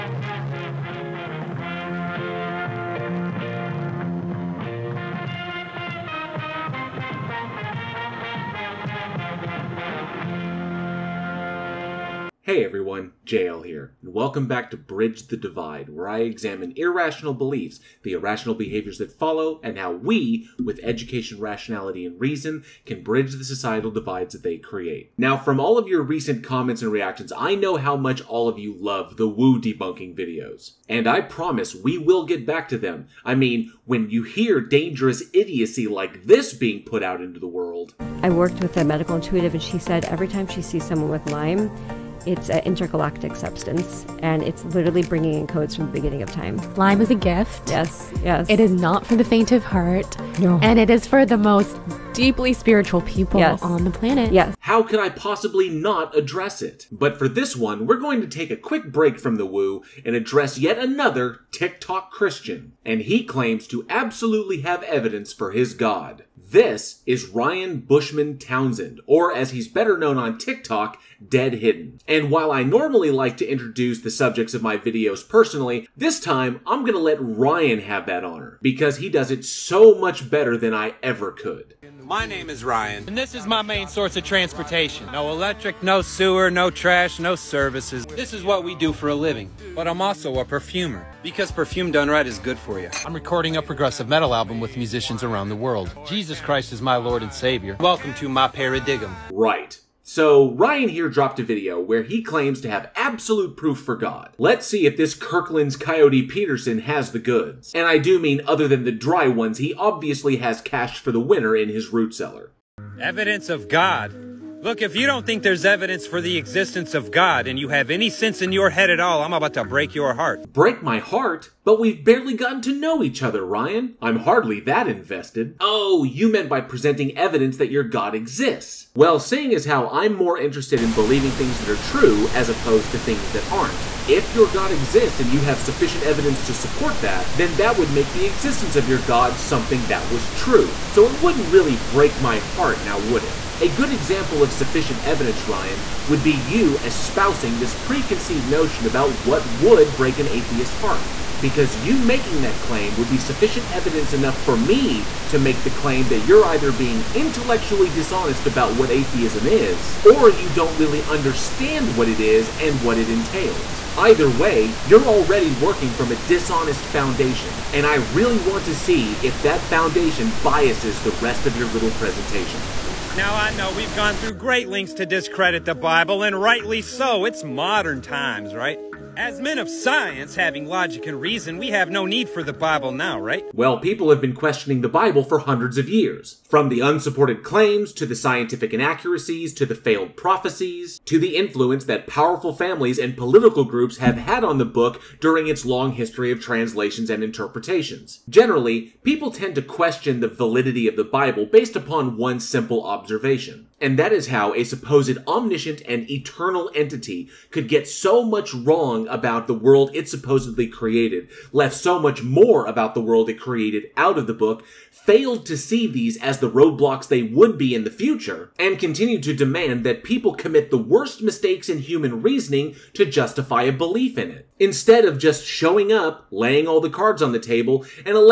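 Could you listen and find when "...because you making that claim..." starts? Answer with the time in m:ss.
2:31.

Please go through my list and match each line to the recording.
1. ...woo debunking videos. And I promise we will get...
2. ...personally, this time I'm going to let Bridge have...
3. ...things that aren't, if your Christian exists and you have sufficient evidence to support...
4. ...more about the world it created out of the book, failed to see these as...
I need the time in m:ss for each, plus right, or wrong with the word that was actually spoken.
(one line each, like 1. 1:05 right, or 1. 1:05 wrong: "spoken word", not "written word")
1. 0:29 right
2. 1:15 wrong: "Ryan", not "Bridge"
3. 2:12 wrong: "God", not "Christian"
4. 3:32 right.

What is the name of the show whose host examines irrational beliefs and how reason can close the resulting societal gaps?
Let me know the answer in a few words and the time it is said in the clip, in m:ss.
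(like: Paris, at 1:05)
Bridge the Divide, at 0:14.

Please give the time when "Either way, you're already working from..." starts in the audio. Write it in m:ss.
2:43.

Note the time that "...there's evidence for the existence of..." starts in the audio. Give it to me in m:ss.
1:55.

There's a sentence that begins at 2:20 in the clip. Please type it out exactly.
So it wouldn't really break my heart now, would it?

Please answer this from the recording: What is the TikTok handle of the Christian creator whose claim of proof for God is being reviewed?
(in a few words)
Dead Hidden.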